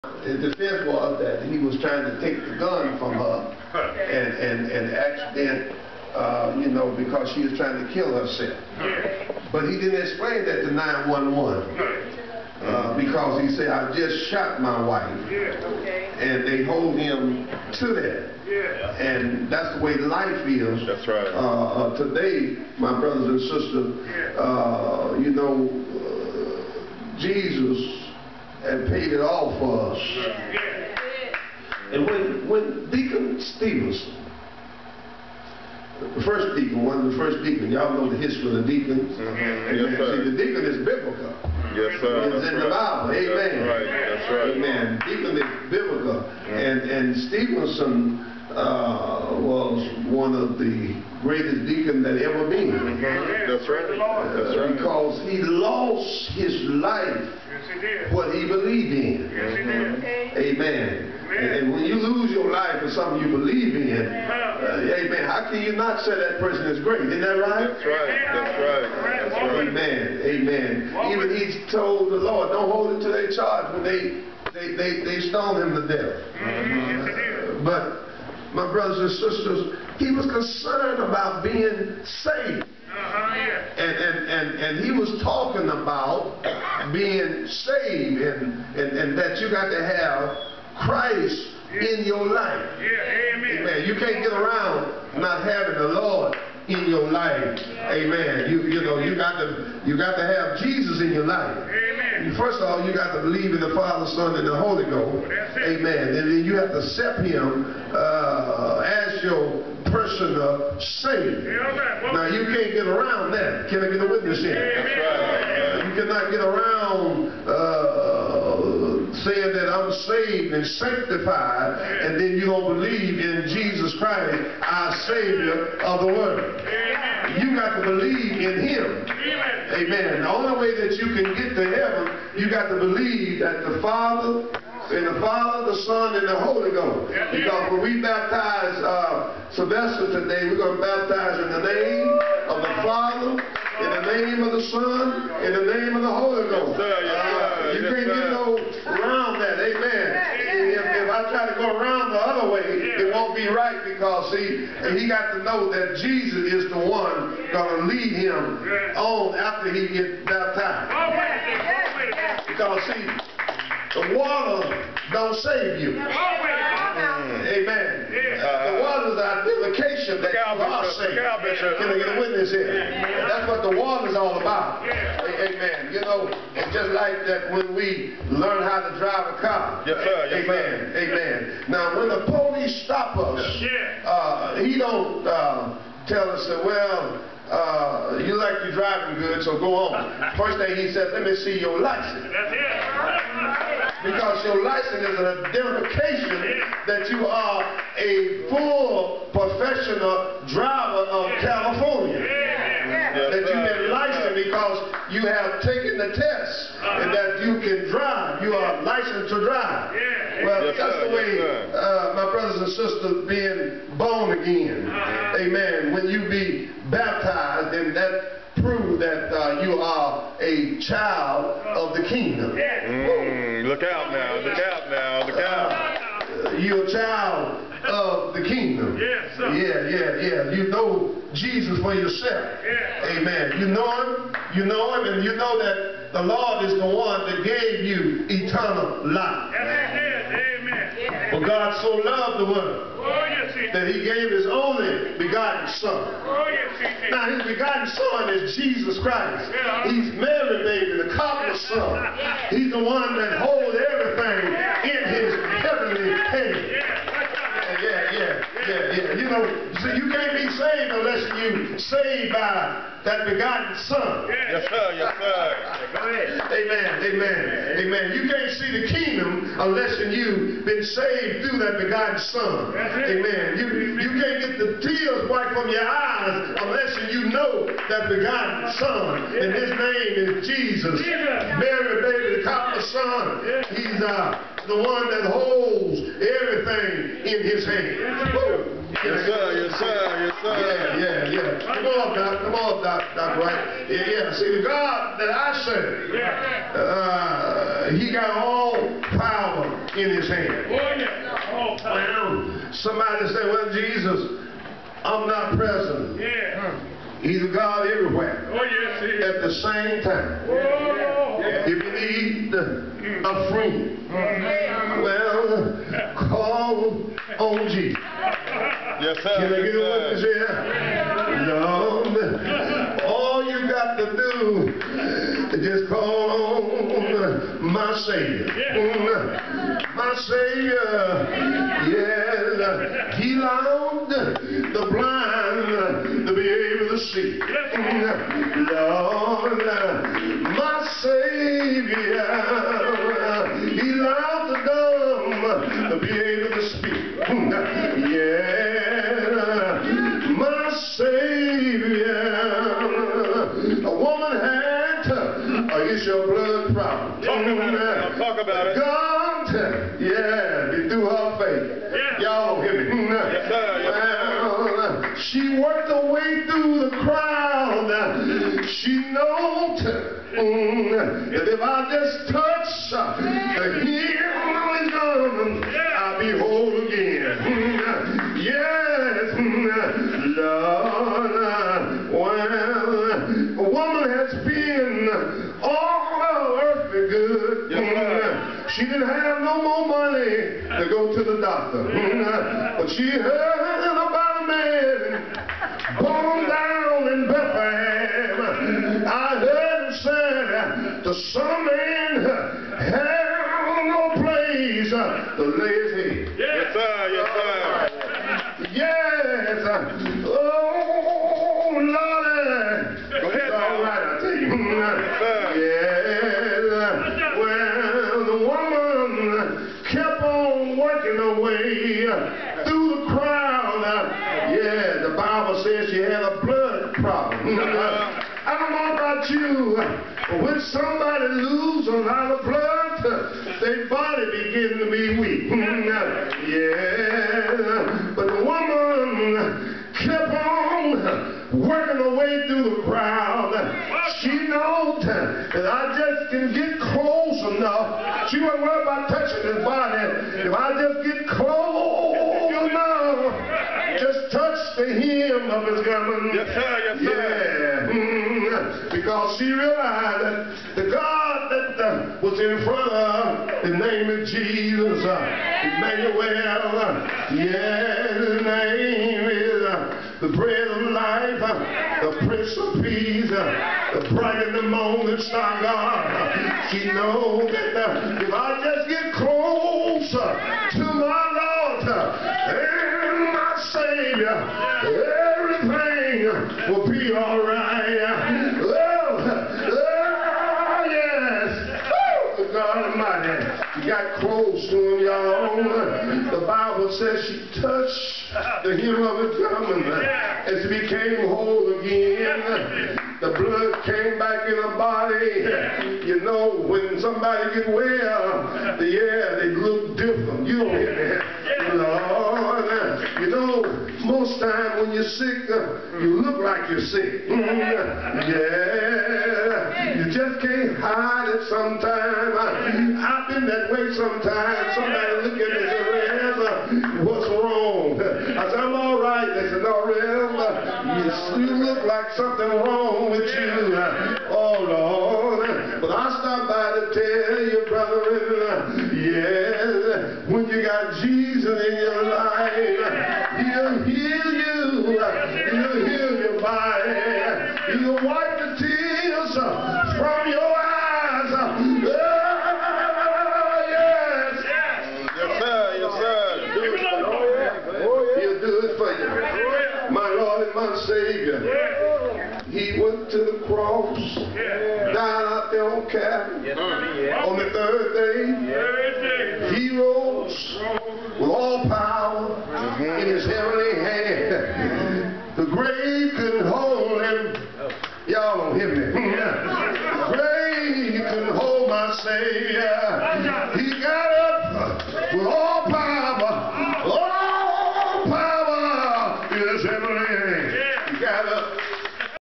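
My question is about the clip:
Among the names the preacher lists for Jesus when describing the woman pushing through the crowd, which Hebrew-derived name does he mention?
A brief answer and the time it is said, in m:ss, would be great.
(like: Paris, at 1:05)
Emmanuel, at 7:45.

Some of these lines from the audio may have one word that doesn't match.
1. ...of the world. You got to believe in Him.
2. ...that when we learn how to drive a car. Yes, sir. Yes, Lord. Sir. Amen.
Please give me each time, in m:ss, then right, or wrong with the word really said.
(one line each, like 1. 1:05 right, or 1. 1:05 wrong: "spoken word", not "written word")
1. 2:05 right
2. 2:57 wrong: "Amen", not "Lord".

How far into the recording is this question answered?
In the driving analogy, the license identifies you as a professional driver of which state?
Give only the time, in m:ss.
3:21.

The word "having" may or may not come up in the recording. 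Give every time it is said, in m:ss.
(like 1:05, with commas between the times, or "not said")
1:35.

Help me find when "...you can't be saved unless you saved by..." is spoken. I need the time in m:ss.
4:19.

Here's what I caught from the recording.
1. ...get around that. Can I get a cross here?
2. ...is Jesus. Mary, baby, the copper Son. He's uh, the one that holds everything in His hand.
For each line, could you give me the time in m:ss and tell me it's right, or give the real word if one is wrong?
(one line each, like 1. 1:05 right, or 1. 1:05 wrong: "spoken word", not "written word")
1. 1:52 wrong: "witness", not "cross"
2. 4:40 right.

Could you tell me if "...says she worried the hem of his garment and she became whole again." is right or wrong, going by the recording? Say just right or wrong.
wrong.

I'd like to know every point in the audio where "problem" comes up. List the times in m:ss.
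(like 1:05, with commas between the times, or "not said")
5:56, 7:06.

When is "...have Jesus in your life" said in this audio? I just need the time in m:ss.
1:40.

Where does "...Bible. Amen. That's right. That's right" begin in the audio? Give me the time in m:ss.
0:42.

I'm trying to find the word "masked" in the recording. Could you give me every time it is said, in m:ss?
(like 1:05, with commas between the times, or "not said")
not said.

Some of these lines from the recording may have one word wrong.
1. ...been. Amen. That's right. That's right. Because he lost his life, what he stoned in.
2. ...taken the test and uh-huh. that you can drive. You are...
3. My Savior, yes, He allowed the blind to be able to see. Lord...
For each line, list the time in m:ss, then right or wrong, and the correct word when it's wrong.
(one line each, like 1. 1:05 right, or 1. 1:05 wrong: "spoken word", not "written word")
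1. 0:52 wrong: "believed", not "stoned"
2. 3:25 right
3. 5:29 right.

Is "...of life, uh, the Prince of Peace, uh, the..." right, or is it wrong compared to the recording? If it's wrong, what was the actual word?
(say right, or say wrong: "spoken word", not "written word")
right.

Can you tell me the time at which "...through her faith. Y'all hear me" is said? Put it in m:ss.
6:00.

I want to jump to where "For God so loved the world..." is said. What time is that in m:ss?
4:01.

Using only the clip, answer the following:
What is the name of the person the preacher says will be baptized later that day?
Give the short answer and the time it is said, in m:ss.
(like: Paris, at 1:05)
Sylvester, at 2:19.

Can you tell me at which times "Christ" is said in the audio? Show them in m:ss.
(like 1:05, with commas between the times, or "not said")
1:30, 2:03, 4:09.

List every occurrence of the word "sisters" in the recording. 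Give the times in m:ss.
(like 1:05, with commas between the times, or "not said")
0:23, 1:19, 3:32.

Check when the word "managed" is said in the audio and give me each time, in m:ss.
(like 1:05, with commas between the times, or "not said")
not said.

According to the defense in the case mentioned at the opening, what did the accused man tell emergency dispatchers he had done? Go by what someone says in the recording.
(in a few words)
I just shot my wife.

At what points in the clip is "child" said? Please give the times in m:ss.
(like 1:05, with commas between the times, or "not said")
3:40, 3:46.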